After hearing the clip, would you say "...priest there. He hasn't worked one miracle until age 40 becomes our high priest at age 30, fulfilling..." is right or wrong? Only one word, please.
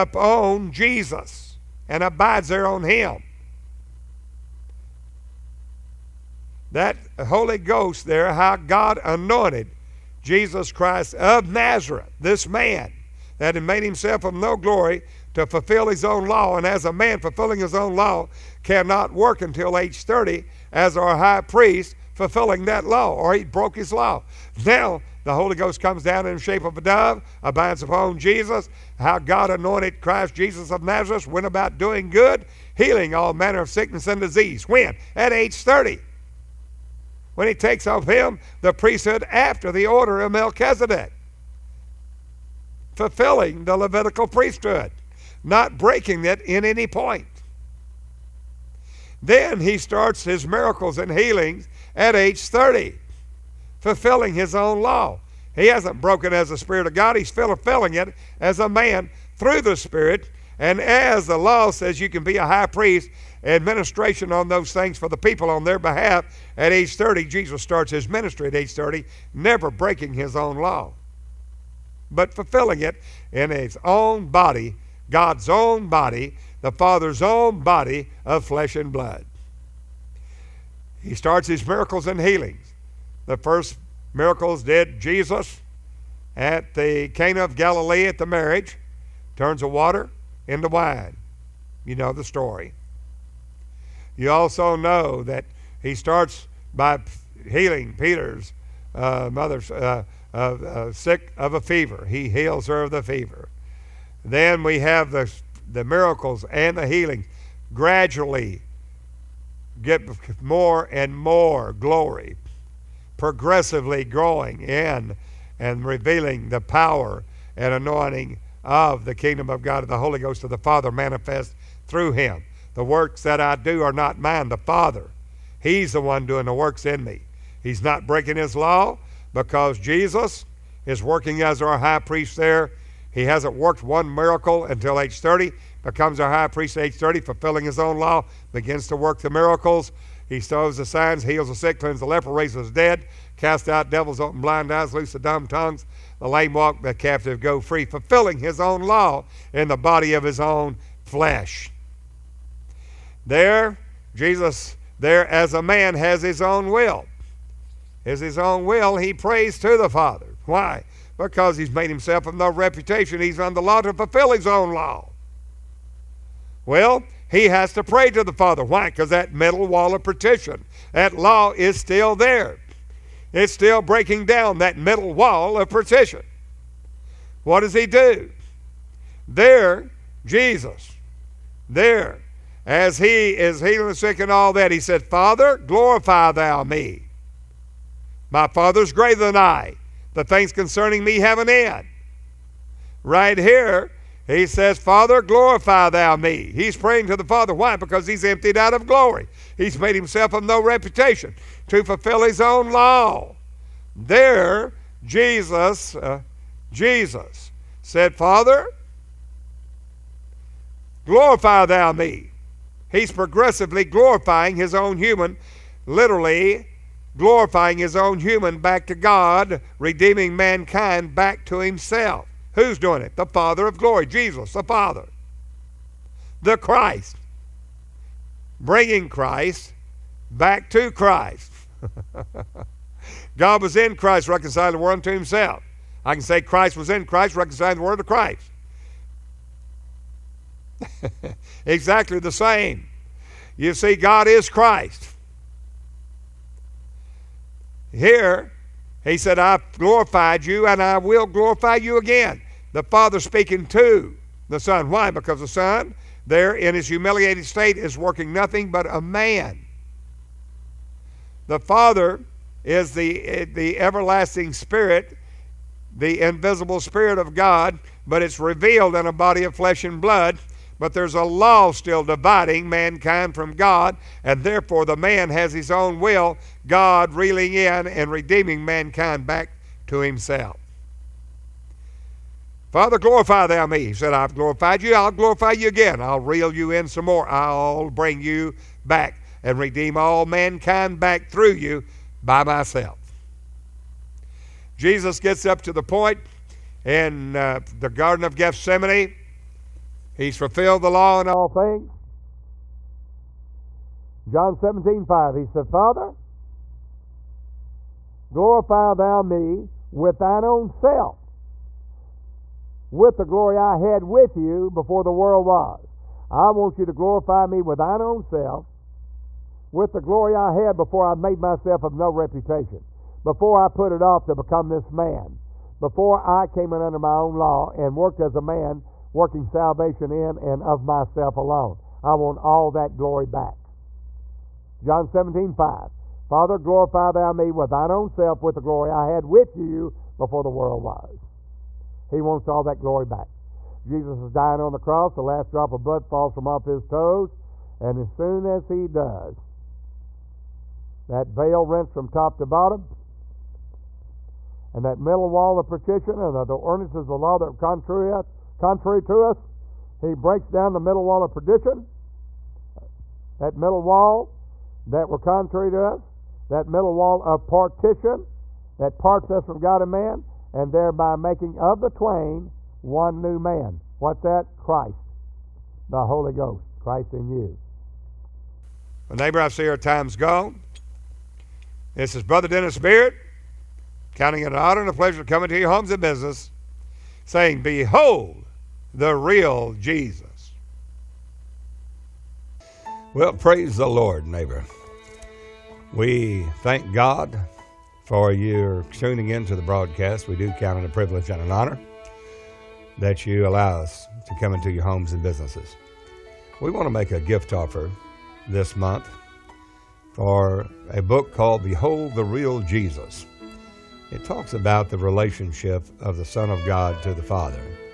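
wrong.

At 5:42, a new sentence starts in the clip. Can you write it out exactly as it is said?
He wants all that glory back.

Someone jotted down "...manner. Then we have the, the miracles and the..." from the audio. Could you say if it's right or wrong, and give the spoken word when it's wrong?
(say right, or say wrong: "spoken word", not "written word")
wrong: "fever", not "manner".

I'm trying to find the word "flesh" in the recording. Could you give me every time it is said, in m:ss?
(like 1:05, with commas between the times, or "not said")
1:18, 2:31, 4:29.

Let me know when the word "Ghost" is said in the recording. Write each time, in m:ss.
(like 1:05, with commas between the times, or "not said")
0:07, 0:25, 2:00, 6:16.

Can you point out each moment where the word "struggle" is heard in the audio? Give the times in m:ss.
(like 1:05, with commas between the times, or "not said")
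not said.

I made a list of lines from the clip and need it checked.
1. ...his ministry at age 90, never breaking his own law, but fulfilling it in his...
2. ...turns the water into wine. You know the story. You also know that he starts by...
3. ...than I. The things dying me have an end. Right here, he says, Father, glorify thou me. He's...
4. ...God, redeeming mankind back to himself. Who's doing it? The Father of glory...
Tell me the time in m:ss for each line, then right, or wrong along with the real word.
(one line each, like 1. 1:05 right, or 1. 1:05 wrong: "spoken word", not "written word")
1. 1:07 wrong: "30", not "90"
2. 1:29 right
3. 3:09 wrong: "concerning", not "dying"
4. 3:38 right.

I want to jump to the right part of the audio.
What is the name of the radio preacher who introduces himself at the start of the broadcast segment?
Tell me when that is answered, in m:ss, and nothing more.
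6:22.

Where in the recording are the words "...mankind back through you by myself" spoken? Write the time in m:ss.
4:50.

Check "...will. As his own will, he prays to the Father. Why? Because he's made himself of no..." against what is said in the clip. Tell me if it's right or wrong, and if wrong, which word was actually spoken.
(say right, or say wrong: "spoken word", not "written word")
right.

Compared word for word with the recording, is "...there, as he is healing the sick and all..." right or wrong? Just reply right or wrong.
right.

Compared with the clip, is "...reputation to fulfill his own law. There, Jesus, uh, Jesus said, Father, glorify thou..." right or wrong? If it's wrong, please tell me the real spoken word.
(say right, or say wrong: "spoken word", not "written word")
right.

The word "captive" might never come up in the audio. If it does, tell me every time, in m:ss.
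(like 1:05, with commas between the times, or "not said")
2:26.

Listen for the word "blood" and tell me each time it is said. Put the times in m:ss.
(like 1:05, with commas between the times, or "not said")
1:18, 4:30, 5:45.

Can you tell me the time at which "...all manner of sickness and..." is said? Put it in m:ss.
0:33.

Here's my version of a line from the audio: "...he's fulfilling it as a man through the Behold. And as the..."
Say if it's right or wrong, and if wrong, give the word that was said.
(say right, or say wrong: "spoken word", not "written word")
wrong: "Spirit", not "Behold".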